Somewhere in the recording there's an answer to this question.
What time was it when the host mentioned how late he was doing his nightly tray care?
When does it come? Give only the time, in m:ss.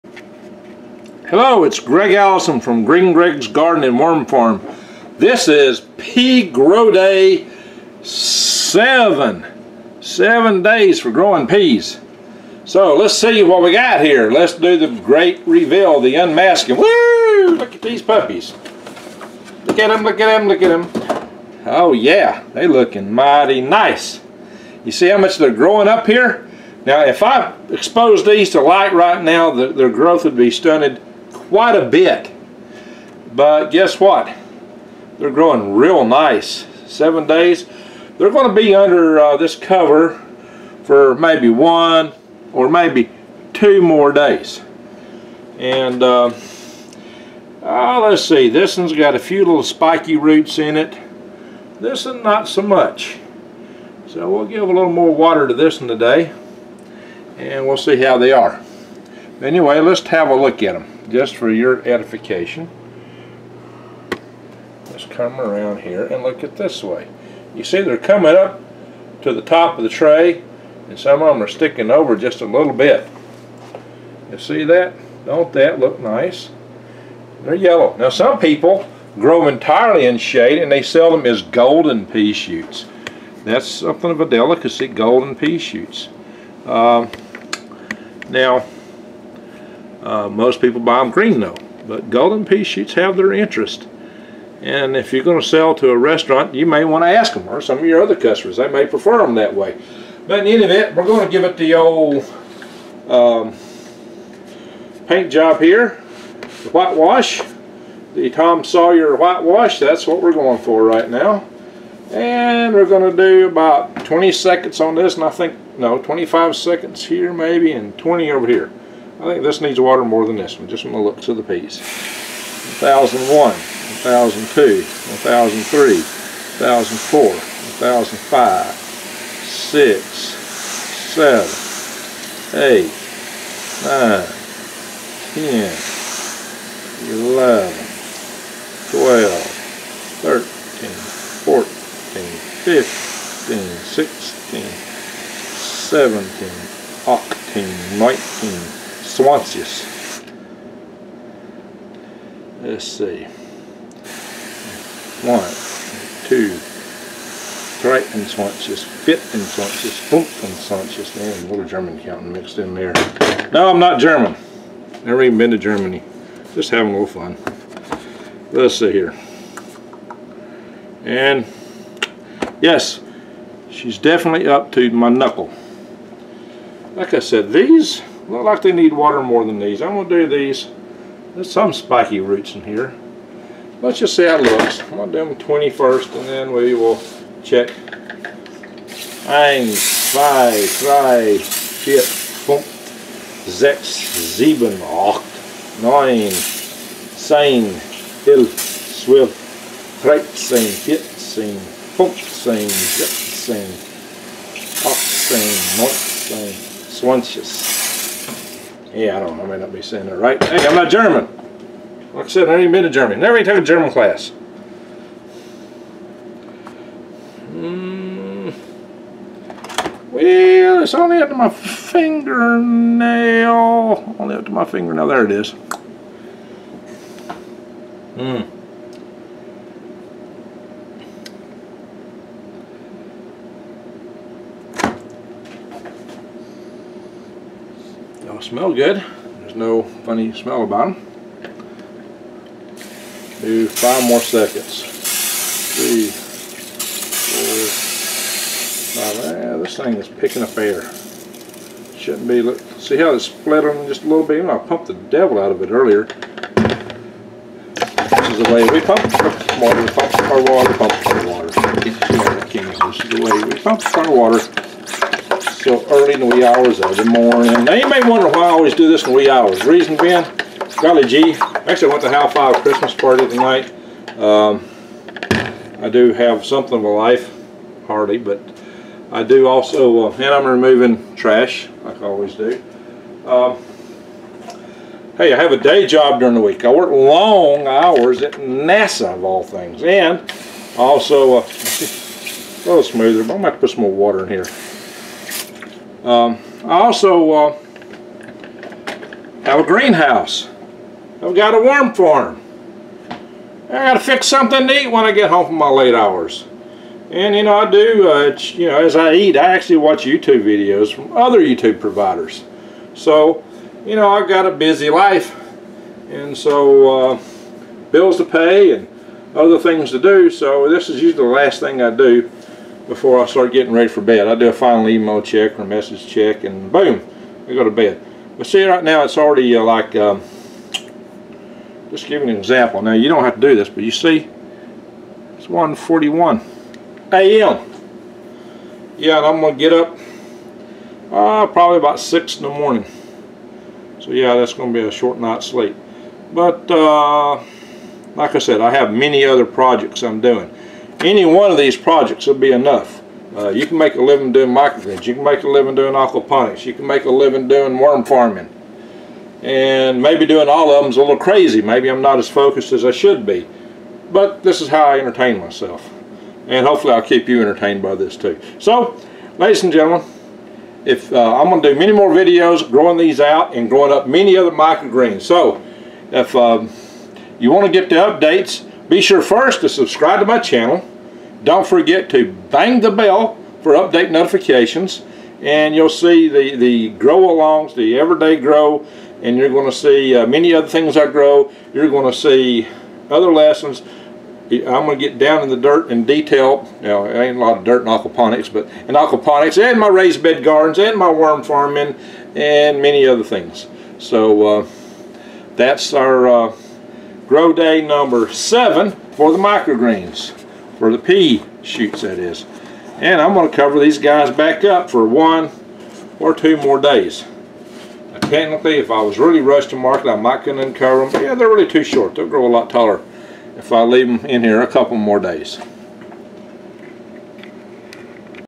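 5:35.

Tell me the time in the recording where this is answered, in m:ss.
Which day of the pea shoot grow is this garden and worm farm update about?
0:06.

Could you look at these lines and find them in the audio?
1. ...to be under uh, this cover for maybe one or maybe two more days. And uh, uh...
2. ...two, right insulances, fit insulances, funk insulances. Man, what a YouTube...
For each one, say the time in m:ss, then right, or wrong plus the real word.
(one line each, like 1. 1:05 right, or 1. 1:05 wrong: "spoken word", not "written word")
1. 0:38 right
2. 2:36 wrong: "German", not "YouTube".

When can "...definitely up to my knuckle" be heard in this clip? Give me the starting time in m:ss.
2:53.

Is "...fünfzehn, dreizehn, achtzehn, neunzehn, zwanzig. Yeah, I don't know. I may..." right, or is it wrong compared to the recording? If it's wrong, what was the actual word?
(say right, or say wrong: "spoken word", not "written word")
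wrong: "sechzehn", not "dreizehn".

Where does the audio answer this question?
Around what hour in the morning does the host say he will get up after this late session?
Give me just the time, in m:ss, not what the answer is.
5:41.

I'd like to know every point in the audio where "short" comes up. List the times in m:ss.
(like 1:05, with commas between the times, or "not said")
5:44, 7:01.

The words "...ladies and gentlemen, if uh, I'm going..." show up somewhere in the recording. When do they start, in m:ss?
6:09.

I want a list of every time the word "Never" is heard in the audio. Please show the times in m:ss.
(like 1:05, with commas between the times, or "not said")
2:45, 3:33.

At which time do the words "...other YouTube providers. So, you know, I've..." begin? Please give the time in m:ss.
5:11.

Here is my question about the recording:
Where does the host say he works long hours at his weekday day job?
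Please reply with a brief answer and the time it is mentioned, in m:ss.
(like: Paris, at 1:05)
NASA, at 4:48.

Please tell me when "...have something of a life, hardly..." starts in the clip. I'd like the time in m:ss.
4:36.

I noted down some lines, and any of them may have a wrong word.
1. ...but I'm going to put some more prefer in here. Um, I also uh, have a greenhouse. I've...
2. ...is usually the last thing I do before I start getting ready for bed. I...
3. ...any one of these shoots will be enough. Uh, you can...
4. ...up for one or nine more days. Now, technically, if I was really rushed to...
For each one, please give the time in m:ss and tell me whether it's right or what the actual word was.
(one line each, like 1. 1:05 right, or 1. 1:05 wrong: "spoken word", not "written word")
1. 4:53 wrong: "water", not "prefer"
2. 5:20 right
3. 5:51 wrong: "projects", not "shoots"
4. 6:54 wrong: "two", not "nine".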